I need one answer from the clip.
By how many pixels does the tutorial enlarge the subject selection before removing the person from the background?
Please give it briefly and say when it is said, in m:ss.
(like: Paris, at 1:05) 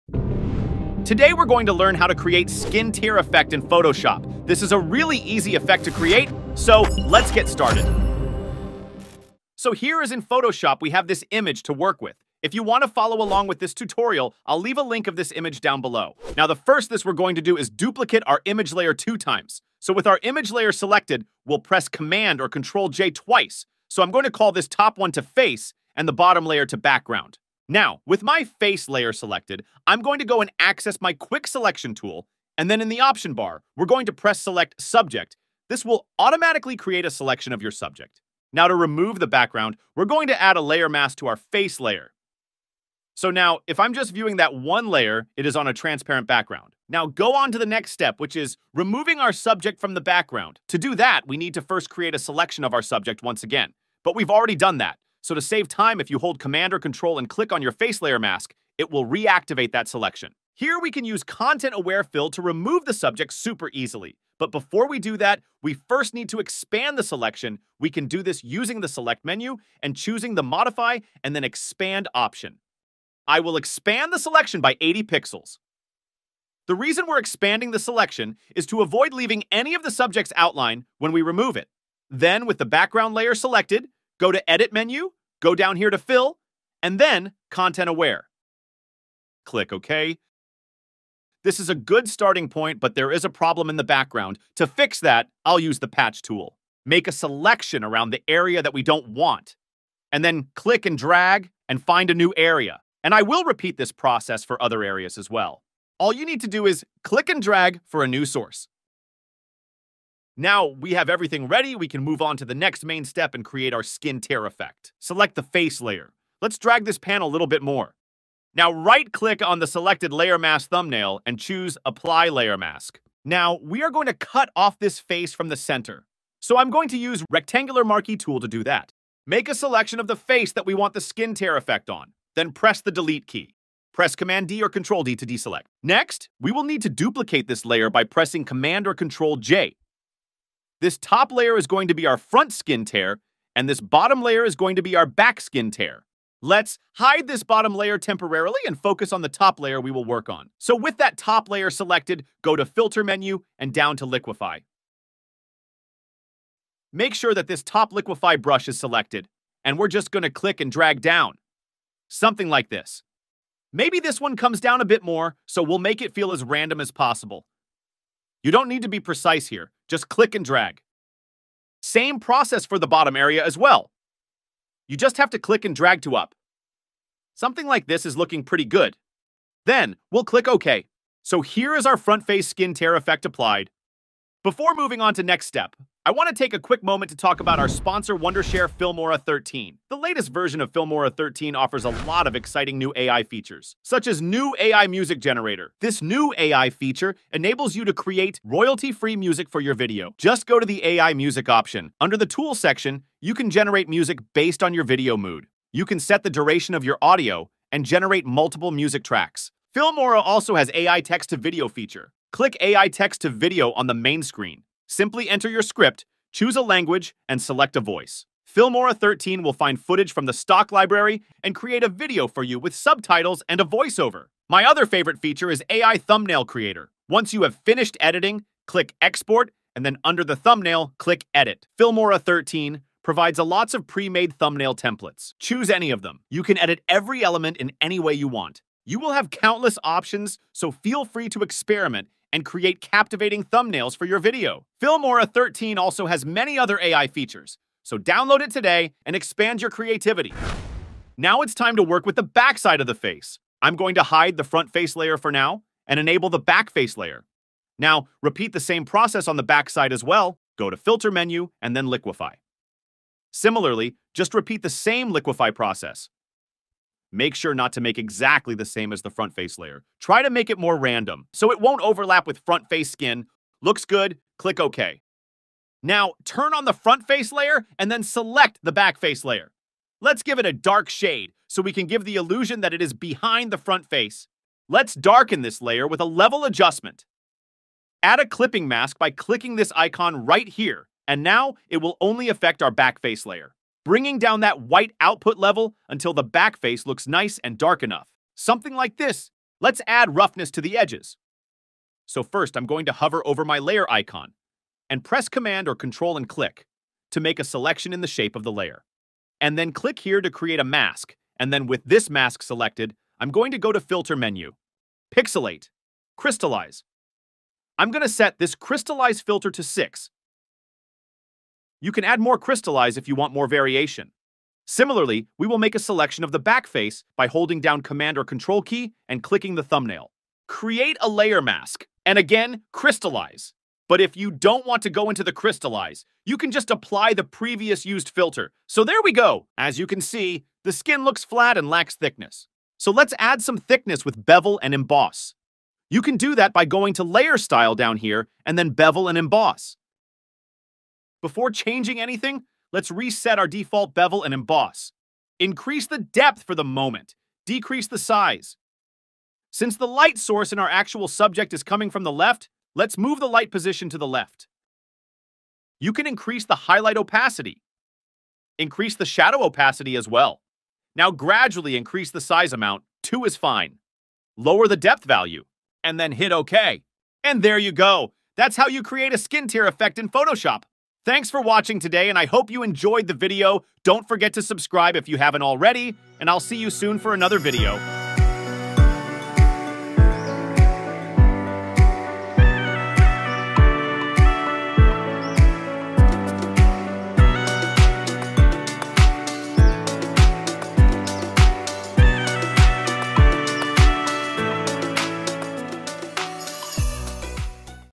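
80, at 1:14.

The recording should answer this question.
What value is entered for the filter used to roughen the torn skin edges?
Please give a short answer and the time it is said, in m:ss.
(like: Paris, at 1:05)
6, at 5:19.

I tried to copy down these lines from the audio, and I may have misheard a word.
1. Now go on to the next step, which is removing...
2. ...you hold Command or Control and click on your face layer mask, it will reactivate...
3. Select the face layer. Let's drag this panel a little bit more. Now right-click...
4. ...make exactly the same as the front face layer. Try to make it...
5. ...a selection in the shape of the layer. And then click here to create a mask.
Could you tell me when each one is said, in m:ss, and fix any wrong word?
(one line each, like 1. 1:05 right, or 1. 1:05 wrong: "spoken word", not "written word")
1. 0:46 right
2. 0:56 right
3. 1:54 right
4. 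4:27 right
5. 5:07 right.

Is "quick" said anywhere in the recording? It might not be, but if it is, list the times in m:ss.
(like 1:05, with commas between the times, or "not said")
0:31, 3:06.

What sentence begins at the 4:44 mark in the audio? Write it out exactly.
Let's darken this layer with a level adjustment.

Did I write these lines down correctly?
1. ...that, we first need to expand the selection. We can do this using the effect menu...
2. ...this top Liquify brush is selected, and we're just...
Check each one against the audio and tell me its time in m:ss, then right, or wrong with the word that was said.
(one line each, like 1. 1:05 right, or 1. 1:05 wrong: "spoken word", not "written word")
1. 1:05 wrong: "select", not "effect"
2. 2:37 right.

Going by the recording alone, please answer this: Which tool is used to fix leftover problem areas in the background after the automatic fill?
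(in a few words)
Patch tool.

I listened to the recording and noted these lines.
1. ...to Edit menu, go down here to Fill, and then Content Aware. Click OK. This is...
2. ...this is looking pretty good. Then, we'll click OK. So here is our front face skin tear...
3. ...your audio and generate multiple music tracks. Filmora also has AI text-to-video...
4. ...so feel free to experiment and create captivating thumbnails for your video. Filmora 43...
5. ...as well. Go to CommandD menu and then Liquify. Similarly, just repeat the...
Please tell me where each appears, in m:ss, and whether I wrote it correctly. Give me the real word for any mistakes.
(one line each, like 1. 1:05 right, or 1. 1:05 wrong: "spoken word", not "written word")
1. 1:24 right
2. 2:57 right
3. 3:26 right
4. 4:00 wrong: "13", not "43"
5. 4:19 wrong: "Filter", not "CommandD".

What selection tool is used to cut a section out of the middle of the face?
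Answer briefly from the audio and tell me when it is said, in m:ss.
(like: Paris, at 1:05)
Rectangular Marquee tool, at 2:07.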